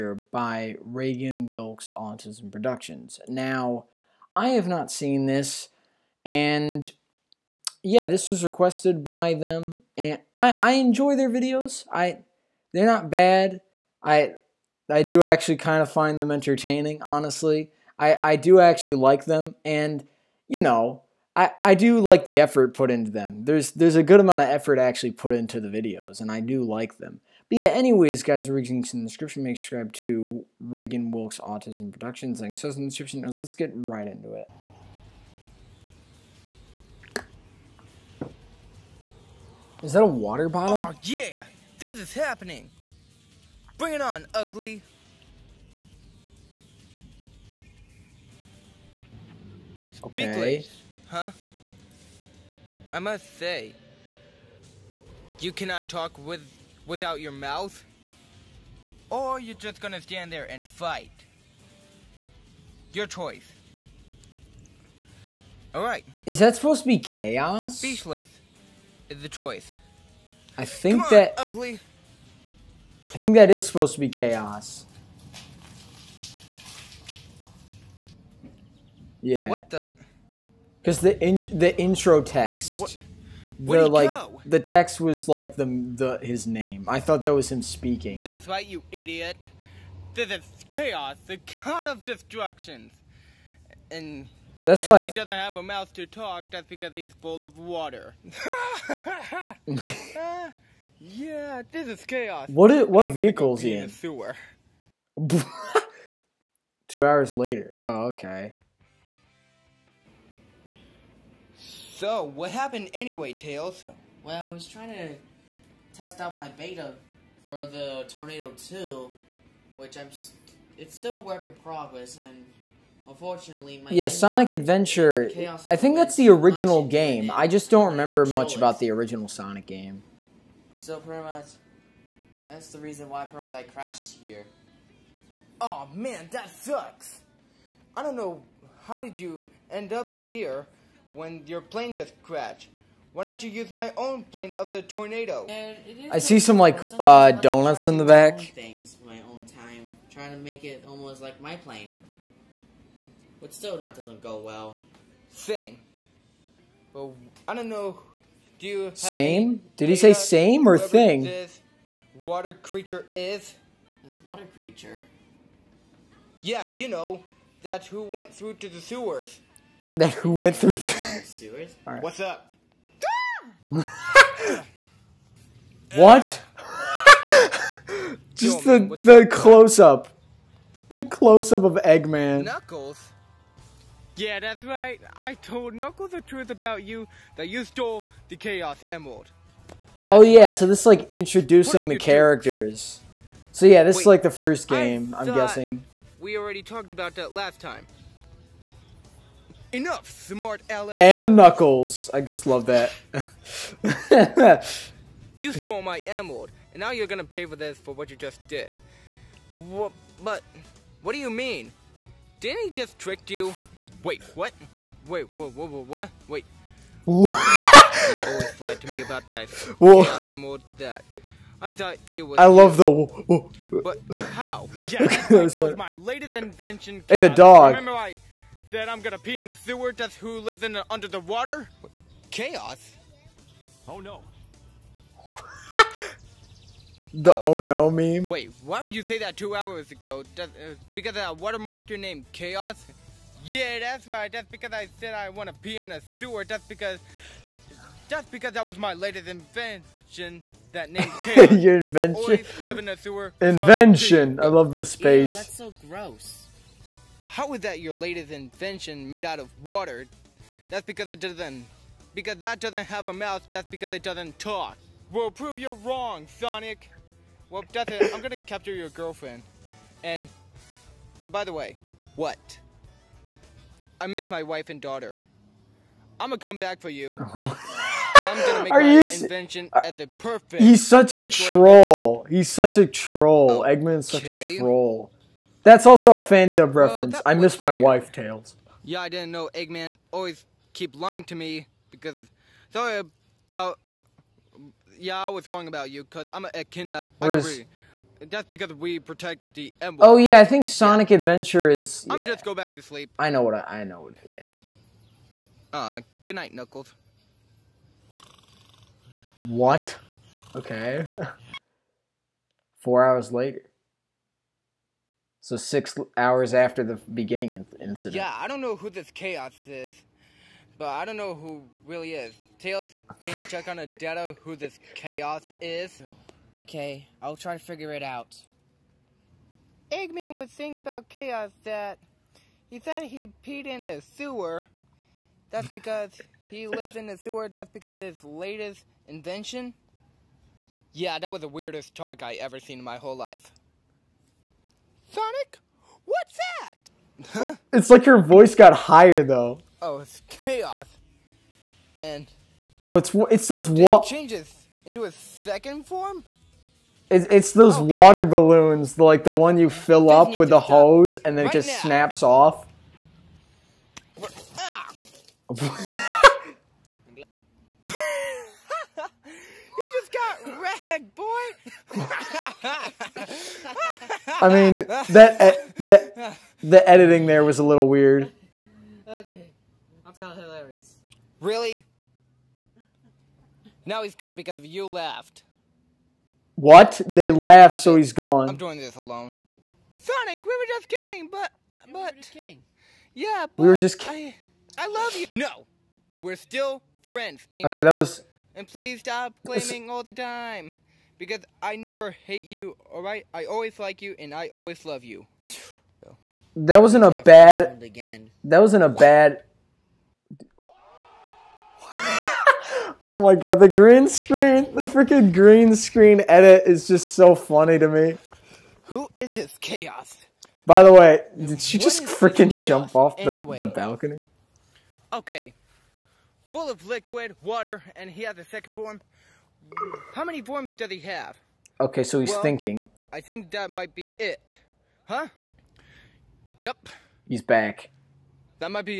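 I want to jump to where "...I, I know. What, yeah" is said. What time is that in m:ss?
5:03.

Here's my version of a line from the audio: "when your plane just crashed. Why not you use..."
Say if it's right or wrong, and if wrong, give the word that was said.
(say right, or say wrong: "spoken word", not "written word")
right.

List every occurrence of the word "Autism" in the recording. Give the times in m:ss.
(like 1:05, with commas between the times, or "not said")
0:01, 0:31.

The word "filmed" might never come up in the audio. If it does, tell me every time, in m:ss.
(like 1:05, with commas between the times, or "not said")
not said.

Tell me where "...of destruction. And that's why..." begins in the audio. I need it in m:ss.
1:31.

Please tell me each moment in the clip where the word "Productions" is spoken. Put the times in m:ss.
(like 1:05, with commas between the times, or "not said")
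0:02, 0:31.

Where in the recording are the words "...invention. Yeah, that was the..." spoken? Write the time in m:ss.
5:39.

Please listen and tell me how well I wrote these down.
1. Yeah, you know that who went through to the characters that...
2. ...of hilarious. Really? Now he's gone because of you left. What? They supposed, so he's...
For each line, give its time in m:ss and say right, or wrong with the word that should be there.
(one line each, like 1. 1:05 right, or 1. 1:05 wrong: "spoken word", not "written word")
1. 2:46 wrong: "sewers", not "characters"
2. 6:20 wrong: "laughed", not "supposed".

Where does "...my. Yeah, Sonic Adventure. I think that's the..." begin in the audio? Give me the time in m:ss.
2:03.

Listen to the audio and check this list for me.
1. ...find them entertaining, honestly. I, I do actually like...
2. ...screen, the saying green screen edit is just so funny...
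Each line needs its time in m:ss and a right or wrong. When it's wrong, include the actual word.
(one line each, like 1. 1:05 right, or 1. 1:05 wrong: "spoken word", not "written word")
1. 0:15 right
2. 6:54 wrong: "freaking", not "saying".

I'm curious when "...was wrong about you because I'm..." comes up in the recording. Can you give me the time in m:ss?
4:55.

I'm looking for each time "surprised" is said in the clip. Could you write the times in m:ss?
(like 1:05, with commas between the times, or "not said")
not said.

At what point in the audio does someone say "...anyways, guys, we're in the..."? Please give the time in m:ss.
0:27.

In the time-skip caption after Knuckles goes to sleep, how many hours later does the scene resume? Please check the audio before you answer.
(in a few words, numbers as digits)
4.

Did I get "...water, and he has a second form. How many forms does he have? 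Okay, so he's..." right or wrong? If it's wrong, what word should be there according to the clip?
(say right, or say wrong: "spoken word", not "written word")
right.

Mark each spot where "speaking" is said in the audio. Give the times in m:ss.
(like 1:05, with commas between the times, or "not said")
1:27.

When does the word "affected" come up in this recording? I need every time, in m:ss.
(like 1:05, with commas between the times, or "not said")
not said.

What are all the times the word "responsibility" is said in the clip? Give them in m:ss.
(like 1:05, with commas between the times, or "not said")
not said.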